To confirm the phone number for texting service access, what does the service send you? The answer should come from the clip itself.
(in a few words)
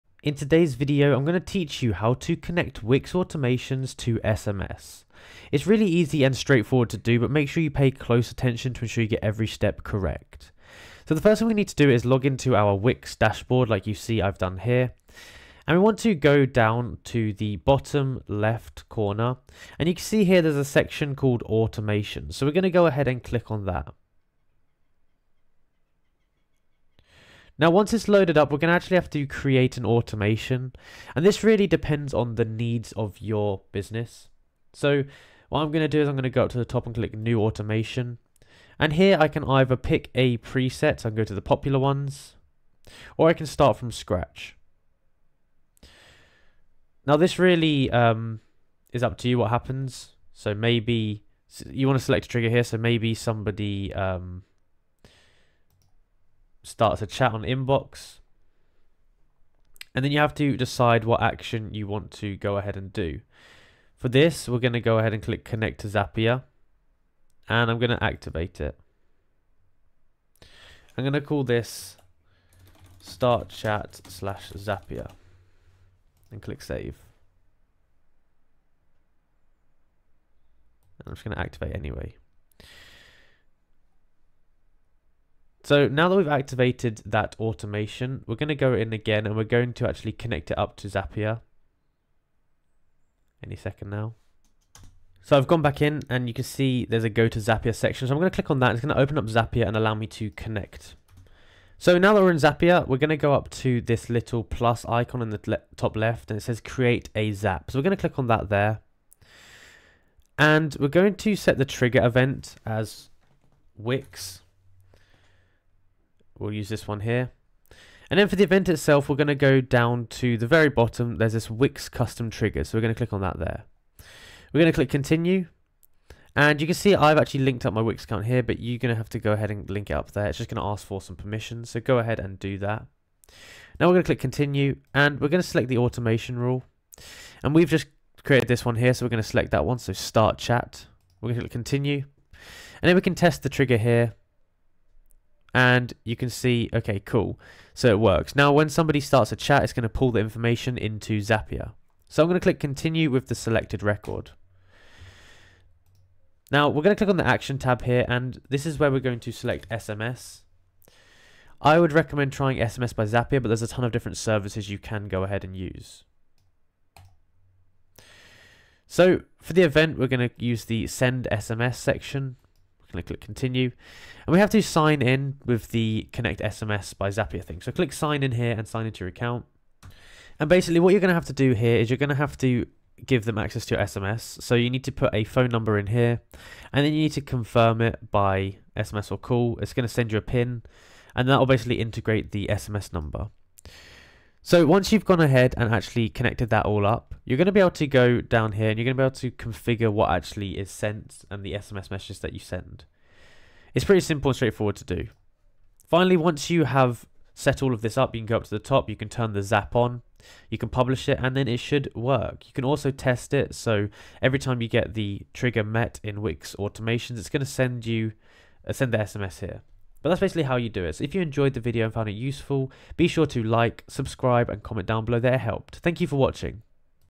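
A pin.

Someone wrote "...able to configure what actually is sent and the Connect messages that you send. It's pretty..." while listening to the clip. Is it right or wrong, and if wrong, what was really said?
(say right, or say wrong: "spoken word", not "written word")
wrong: "SMS", not "Connect".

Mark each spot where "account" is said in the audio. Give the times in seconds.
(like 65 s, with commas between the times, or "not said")
128 s, 179 s.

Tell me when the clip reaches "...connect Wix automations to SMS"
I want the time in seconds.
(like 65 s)
2 s.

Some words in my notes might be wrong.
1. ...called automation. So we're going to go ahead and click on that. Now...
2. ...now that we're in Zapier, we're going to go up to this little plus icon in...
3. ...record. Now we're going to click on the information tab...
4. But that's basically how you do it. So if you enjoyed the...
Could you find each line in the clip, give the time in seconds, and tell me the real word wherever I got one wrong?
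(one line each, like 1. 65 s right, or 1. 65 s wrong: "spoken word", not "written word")
1. 21 s right
2. 101 s right
3. 153 s wrong: "action", not "information"
4. 220 s right.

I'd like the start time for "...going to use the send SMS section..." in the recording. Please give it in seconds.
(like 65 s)
170 s.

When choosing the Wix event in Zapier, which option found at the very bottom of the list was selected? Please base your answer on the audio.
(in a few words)
Wix custom trigger.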